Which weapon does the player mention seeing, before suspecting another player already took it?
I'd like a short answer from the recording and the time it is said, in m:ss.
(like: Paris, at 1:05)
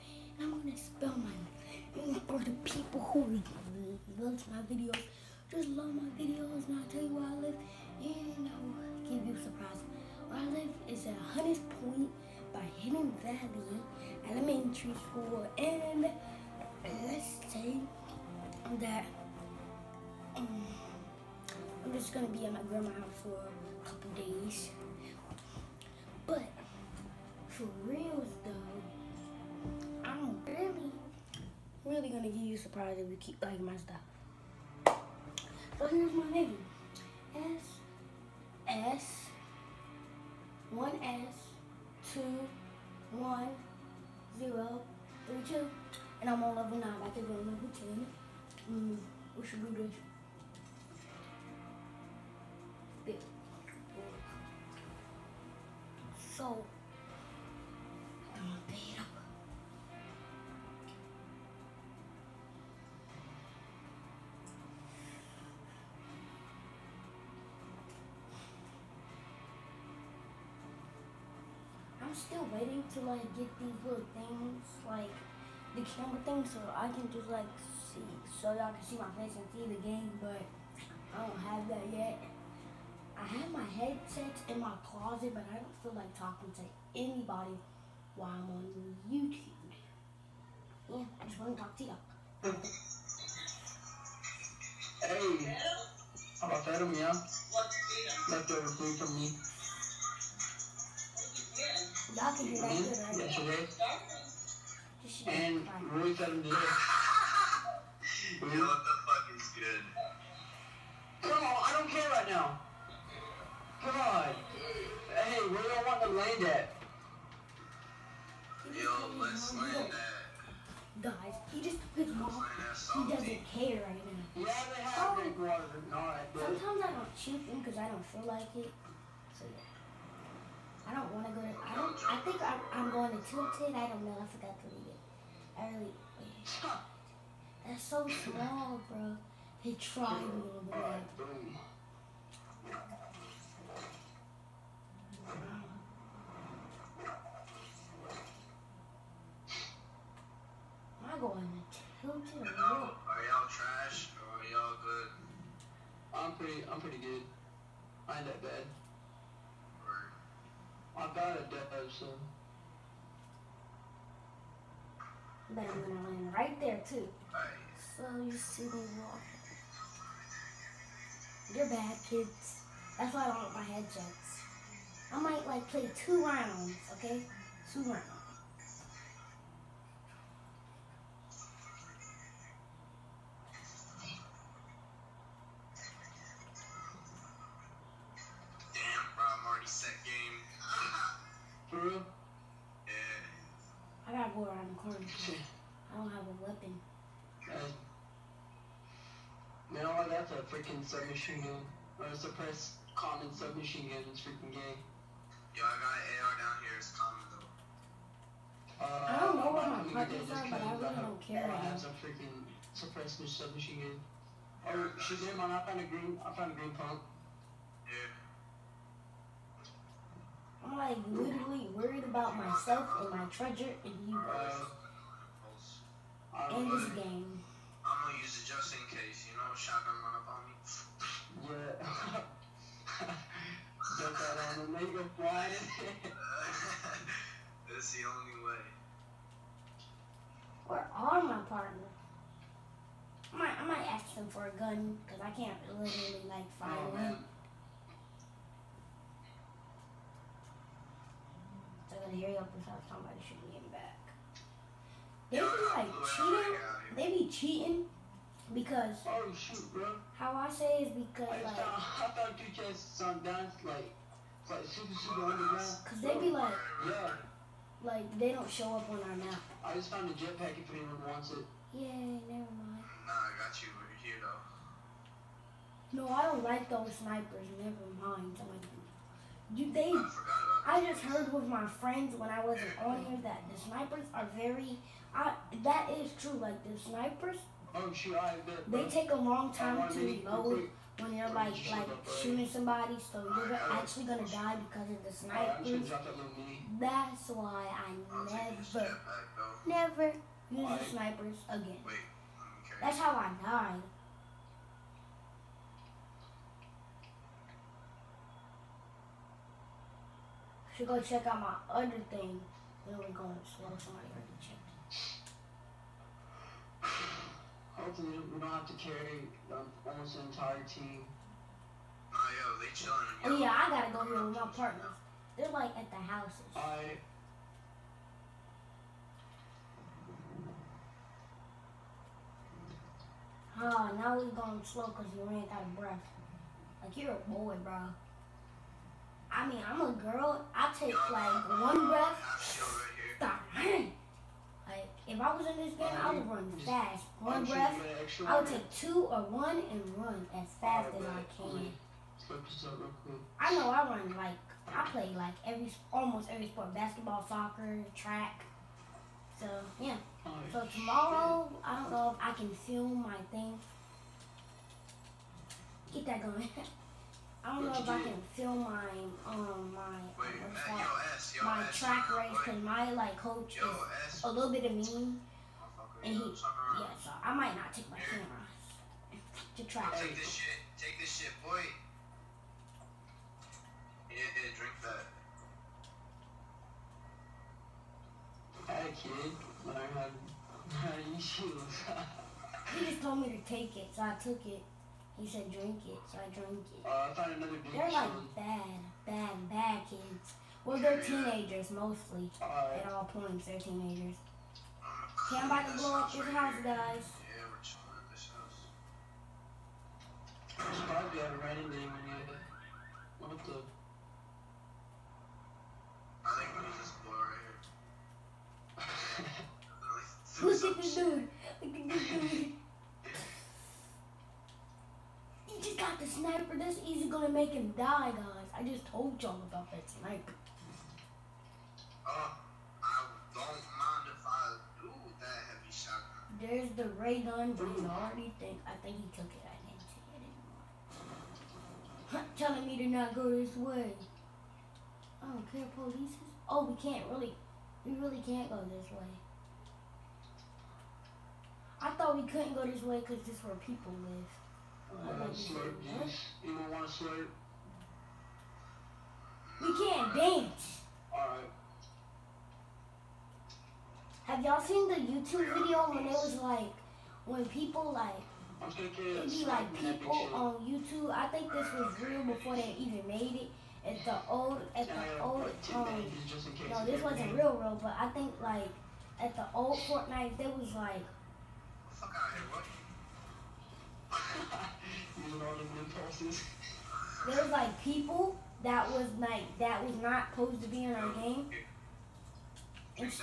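Ray gun, at 7:17.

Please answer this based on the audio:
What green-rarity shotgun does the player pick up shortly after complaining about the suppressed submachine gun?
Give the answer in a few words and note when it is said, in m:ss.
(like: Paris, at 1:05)
Green pump, at 3:36.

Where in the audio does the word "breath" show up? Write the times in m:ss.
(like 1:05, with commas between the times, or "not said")
5:35, 5:41, 5:47.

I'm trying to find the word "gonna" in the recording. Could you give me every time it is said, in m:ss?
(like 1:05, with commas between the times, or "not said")
0:22, 0:32, 2:45, 3:48, 4:12, 4:54, 7:07.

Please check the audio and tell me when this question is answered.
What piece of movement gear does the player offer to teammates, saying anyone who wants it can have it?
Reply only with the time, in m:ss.
4:30.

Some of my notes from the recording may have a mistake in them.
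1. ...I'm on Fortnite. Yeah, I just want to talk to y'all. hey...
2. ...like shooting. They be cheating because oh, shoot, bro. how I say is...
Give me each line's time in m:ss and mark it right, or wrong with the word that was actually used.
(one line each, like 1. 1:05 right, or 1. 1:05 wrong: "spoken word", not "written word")
1. 1:28 wrong: "YouTube", not "Fortnite"
2. 4:15 wrong: "cheating", not "shooting".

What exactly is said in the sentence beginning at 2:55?
I might like play two rounds, okay?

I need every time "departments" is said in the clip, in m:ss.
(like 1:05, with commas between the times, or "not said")
not said.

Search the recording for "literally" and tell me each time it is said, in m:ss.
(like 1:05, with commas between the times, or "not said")
3:41, 4:05.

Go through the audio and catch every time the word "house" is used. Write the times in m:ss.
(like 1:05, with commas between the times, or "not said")
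0:22, 5:25, 6:46.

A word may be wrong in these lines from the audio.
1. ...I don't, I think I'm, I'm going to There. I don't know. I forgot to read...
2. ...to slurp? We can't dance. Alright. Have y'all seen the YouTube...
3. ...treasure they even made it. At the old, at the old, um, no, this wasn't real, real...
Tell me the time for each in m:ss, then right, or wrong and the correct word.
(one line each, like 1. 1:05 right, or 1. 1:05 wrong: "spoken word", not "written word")
1. 2:11 wrong: "Tilted", not "There"
2. 7:36 right
3. 7:52 wrong: "before", not "treasure".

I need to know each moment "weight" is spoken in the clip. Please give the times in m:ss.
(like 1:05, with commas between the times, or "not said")
not said.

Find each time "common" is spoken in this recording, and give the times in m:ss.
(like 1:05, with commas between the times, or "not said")
3:22, 3:26.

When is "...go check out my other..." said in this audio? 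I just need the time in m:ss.
5:10.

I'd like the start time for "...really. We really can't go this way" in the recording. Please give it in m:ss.
7:27.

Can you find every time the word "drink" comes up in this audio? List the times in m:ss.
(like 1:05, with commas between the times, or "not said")
6:24, 6:35.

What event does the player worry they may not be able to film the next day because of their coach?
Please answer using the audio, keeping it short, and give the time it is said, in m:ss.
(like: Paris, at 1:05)
Track race, at 6:11.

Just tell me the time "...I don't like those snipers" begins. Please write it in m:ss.
4:36.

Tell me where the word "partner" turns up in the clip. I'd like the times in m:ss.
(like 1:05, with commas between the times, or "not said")
4:01, 5:24.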